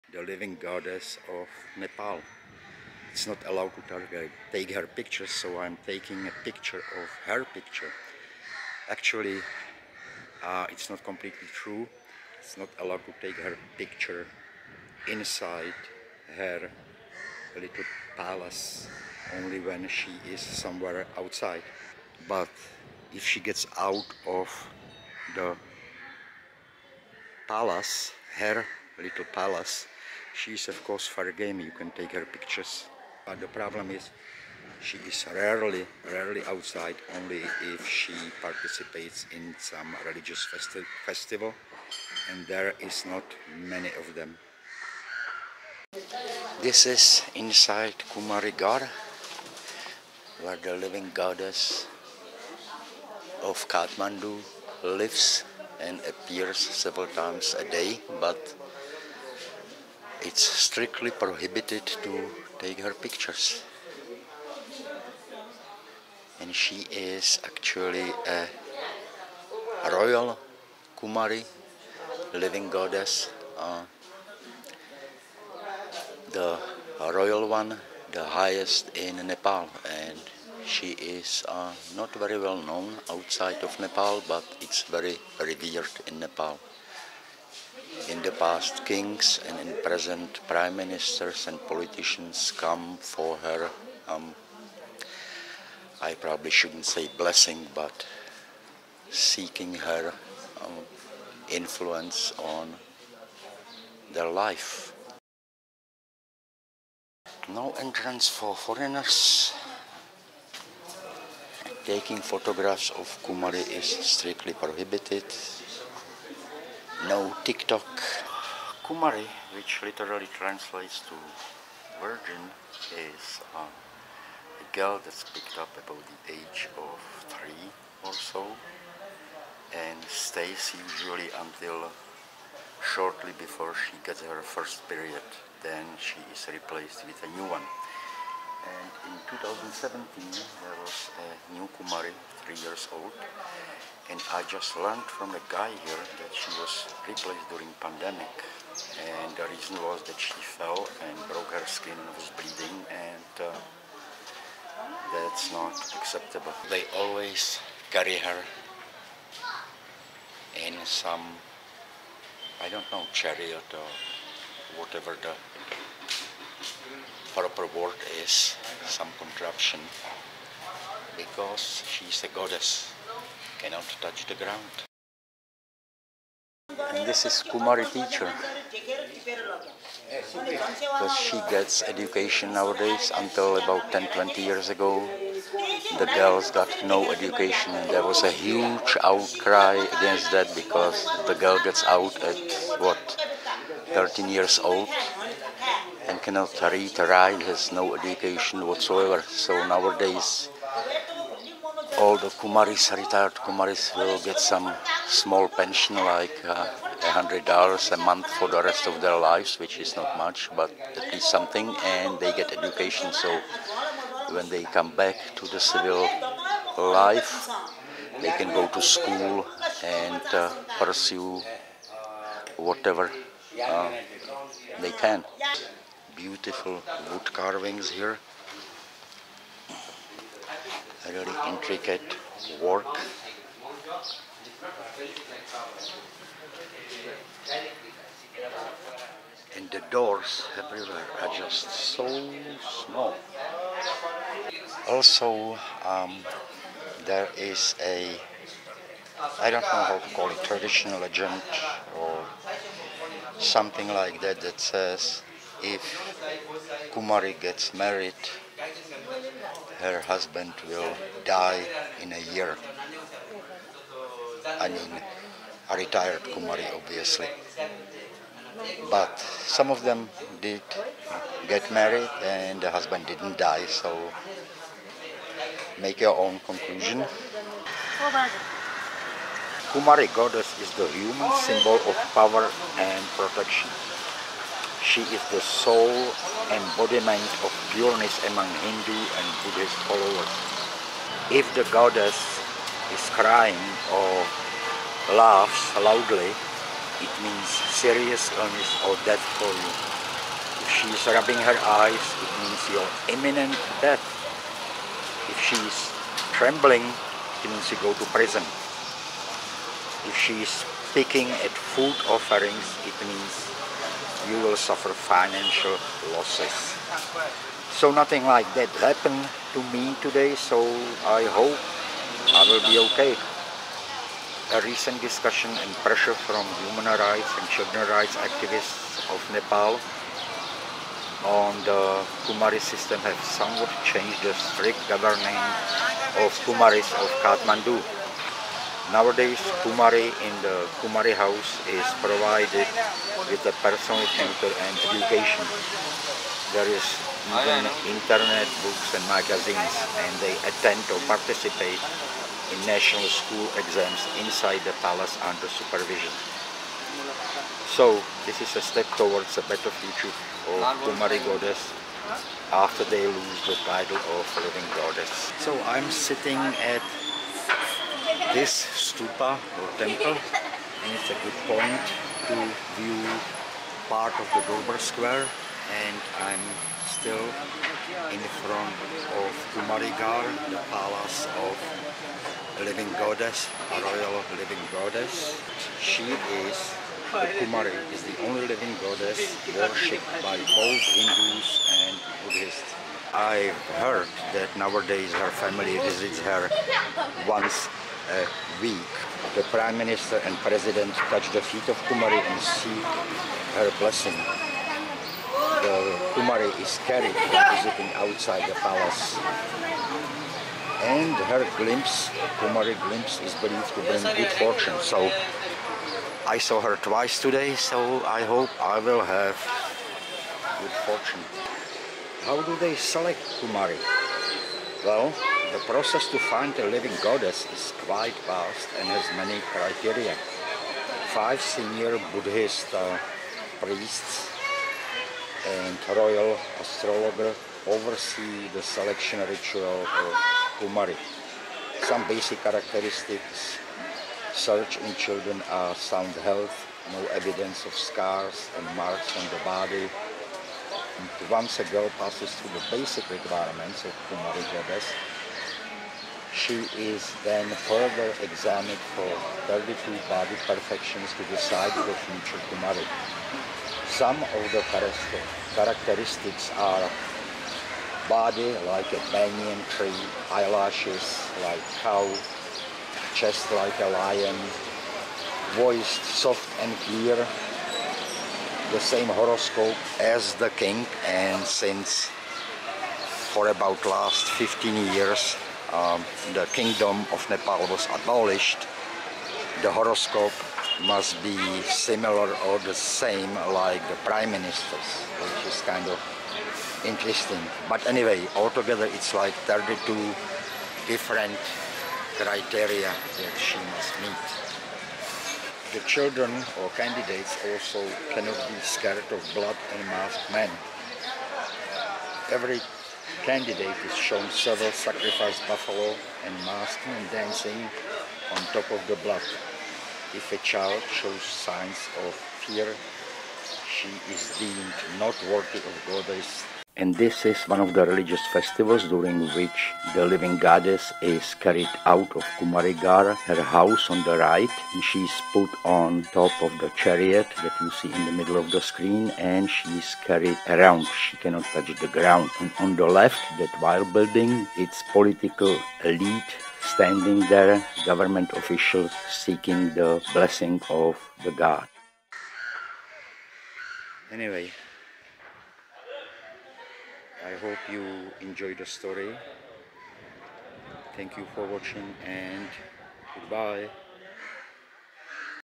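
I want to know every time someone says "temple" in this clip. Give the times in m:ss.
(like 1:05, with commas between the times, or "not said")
6:09.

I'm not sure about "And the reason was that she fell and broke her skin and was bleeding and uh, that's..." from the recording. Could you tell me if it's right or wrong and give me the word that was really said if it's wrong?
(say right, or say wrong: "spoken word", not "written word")
right.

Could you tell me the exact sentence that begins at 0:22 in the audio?
But if she gets out of the palace, her little palace, She's of course game.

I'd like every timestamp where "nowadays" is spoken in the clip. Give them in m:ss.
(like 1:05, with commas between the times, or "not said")
3:02, 3:19, 5:38, 6:34.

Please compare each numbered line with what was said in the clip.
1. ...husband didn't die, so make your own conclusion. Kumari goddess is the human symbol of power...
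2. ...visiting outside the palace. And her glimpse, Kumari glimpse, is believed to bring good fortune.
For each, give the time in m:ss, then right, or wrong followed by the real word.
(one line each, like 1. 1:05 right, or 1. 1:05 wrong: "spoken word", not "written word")
1. 4:32 right
2. 6:47 right.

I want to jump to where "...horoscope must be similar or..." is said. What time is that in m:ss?
8:09.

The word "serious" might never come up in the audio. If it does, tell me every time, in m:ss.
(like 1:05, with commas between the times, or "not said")
4:57.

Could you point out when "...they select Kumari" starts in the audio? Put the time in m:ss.
7:02.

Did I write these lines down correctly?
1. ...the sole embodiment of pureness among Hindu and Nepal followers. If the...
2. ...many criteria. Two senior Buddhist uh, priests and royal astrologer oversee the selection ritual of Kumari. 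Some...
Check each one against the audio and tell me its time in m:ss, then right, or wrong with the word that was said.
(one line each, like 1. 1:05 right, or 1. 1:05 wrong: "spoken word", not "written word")
1. 4:45 wrong: "Buddhist", not "Nepal"
2. 7:09 wrong: "Five", not "Two".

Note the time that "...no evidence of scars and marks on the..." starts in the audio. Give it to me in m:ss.
7:26.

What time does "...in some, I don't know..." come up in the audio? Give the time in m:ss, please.
2:40.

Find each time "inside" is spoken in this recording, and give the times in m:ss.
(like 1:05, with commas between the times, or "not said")
0:15, 0:47, 5:54.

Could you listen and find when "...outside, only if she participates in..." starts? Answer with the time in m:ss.
0:36.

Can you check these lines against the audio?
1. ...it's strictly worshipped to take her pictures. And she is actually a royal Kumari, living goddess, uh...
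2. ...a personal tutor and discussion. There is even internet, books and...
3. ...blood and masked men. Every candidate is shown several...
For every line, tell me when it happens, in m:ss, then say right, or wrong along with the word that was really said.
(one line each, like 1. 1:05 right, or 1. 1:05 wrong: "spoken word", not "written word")
1. 1:00 wrong: "prohibited", not "worshipped"
2. 5:43 wrong: "education", not "discussion"
3. 8:29 right.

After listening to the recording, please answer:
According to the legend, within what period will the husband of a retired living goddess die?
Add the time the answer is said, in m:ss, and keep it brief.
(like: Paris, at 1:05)
a year, at 4:22.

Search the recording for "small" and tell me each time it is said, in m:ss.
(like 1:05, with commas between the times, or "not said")
3:25, 4:02.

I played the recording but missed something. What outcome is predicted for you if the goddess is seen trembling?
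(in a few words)
you go to prison.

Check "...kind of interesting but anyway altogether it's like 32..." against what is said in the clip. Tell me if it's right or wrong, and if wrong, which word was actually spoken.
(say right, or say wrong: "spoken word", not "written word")
right.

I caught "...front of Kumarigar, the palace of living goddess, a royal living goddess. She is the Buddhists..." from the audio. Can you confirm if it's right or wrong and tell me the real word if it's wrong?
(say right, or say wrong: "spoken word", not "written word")
wrong: "Kumari", not "Buddhists".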